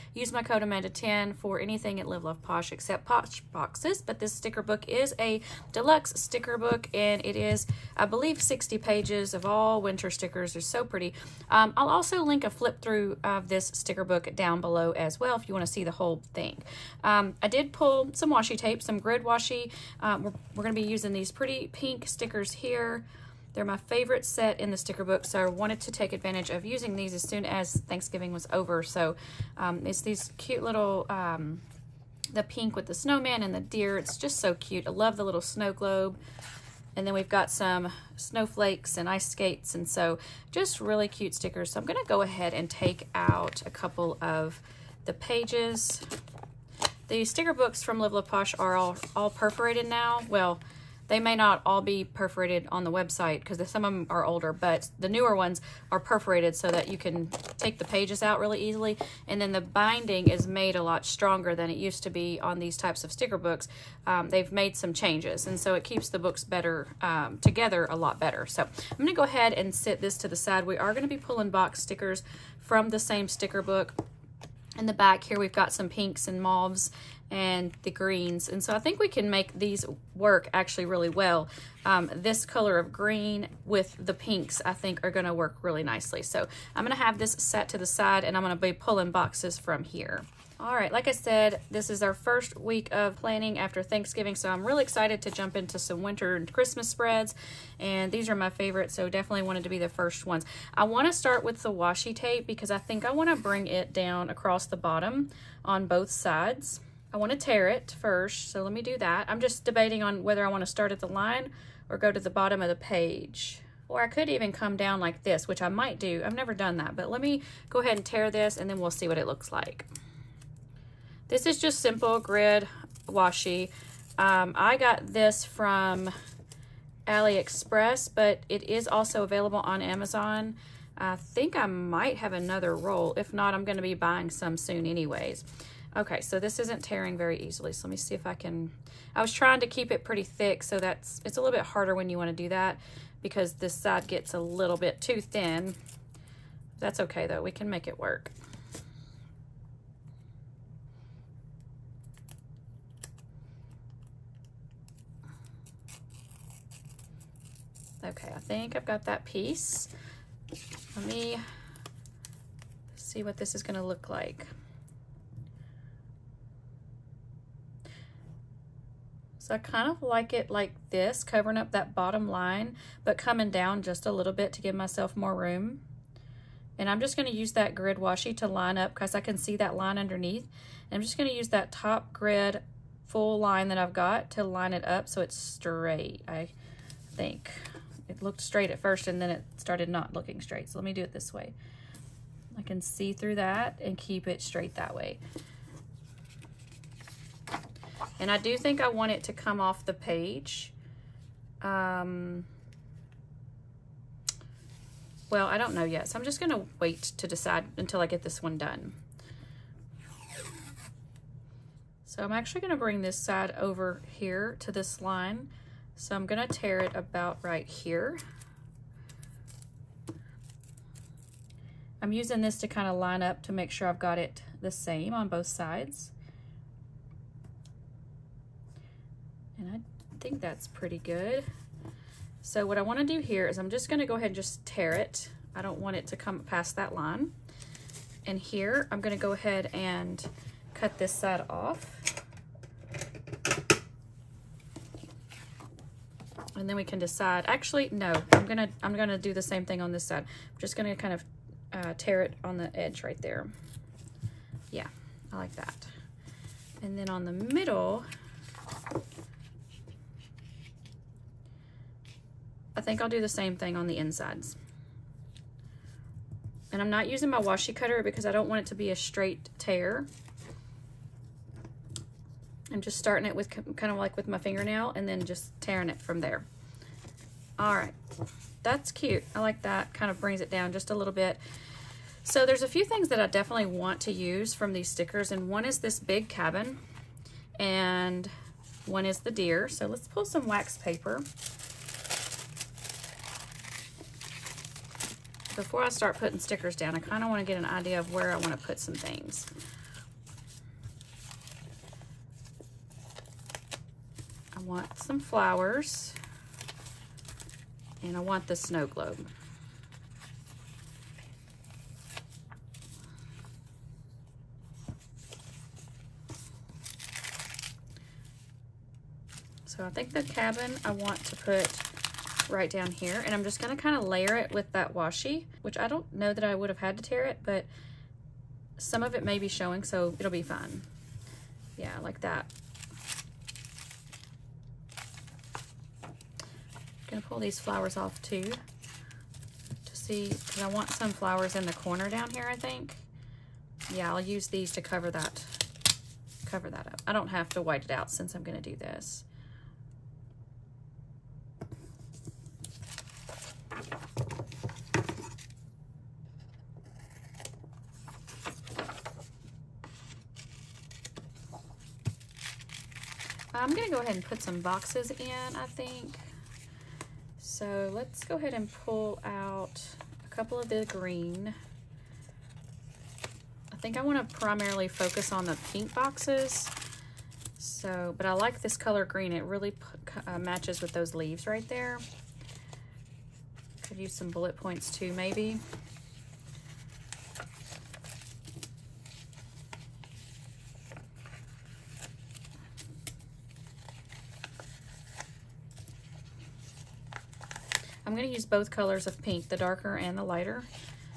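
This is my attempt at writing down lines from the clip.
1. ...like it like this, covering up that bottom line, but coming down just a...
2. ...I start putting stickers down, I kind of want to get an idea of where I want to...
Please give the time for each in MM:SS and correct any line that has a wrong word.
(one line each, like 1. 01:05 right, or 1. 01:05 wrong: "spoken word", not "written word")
1. 02:50 right
2. 04:55 right.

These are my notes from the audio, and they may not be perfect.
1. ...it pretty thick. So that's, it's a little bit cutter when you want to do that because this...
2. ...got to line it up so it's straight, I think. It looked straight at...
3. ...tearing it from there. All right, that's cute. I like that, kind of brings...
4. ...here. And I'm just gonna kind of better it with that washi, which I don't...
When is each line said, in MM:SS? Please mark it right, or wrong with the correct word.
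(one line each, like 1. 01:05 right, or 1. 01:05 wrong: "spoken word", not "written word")
1. 02:19 wrong: "harder", not "cutter"
2. 03:03 right
3. 04:35 right
4. 05:22 wrong: "layer", not "better".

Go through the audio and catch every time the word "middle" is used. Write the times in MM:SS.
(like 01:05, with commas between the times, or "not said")
04:17.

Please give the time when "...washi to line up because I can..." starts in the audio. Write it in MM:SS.
02:57.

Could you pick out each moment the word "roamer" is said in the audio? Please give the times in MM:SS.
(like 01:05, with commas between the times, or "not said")
not said.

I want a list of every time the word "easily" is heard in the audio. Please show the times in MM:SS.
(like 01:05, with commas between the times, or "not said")
00:58, 02:17.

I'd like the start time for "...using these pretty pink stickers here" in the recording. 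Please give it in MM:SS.
00:20.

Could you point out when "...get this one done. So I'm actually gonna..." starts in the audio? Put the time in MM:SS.
03:28.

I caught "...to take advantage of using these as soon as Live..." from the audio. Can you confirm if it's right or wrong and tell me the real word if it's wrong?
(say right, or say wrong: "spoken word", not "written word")
wrong: "Thanksgiving", not "Live".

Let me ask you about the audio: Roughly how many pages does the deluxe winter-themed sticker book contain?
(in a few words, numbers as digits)
60.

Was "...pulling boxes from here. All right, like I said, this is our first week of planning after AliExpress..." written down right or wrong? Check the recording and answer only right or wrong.
wrong.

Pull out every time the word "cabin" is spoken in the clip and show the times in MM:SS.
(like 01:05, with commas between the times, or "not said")
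04:46, 05:20.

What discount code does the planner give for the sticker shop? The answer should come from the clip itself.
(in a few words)
AMANDA10.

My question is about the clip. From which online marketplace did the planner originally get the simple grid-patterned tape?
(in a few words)
AliExpress.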